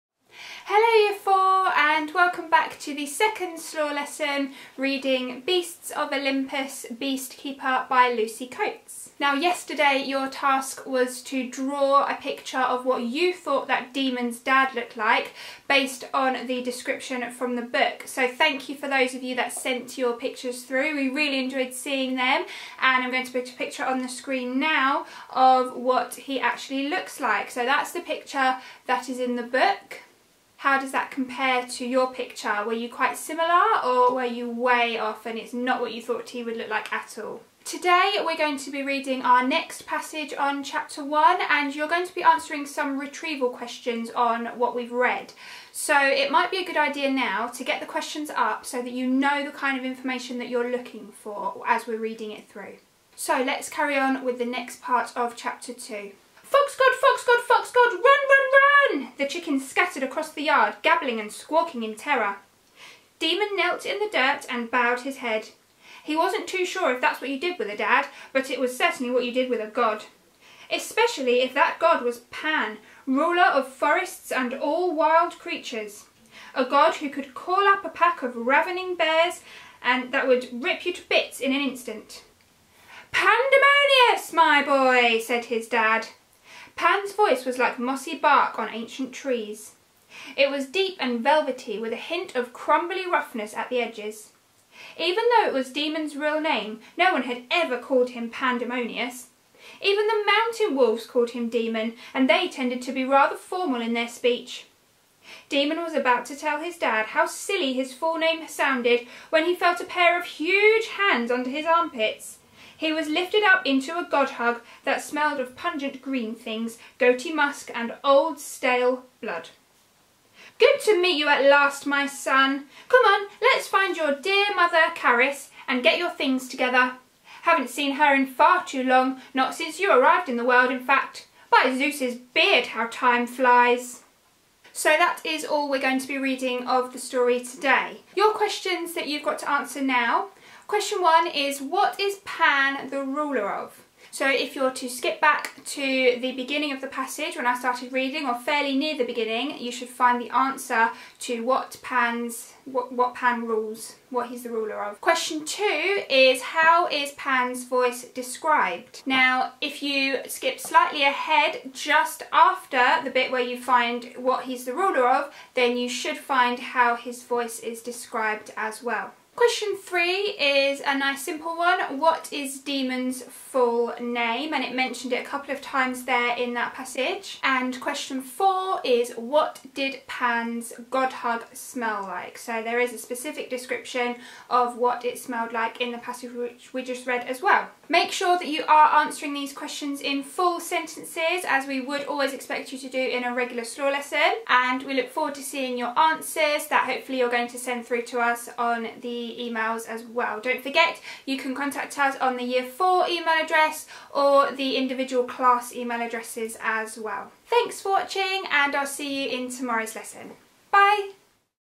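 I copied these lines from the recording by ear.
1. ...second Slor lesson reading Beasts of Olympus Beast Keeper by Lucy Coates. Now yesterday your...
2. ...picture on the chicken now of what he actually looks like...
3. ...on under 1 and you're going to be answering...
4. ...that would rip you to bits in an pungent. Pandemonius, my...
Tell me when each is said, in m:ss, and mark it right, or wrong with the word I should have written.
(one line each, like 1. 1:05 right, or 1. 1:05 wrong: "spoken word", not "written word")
1. 0:03 right
2. 0:23 wrong: "screen", not "chicken"
3. 0:40 wrong: "chapter", not "under"
4. 1:20 wrong: "instant", not "pungent".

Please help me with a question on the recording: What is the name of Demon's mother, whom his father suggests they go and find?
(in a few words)
Caris.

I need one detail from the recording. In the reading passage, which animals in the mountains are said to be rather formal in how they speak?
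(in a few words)
Mountain wolves.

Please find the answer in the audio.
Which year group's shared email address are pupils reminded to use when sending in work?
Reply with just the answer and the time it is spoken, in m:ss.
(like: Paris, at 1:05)
Year 4, at 3:22.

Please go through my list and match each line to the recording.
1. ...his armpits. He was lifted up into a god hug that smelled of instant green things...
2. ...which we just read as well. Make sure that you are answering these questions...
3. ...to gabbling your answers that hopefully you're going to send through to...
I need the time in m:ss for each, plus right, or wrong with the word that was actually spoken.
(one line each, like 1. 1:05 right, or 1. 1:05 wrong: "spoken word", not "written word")
1. 1:51 wrong: "pungent", not "instant"
2. 3:06 right
3. 3:15 wrong: "seeing", not "gabbling".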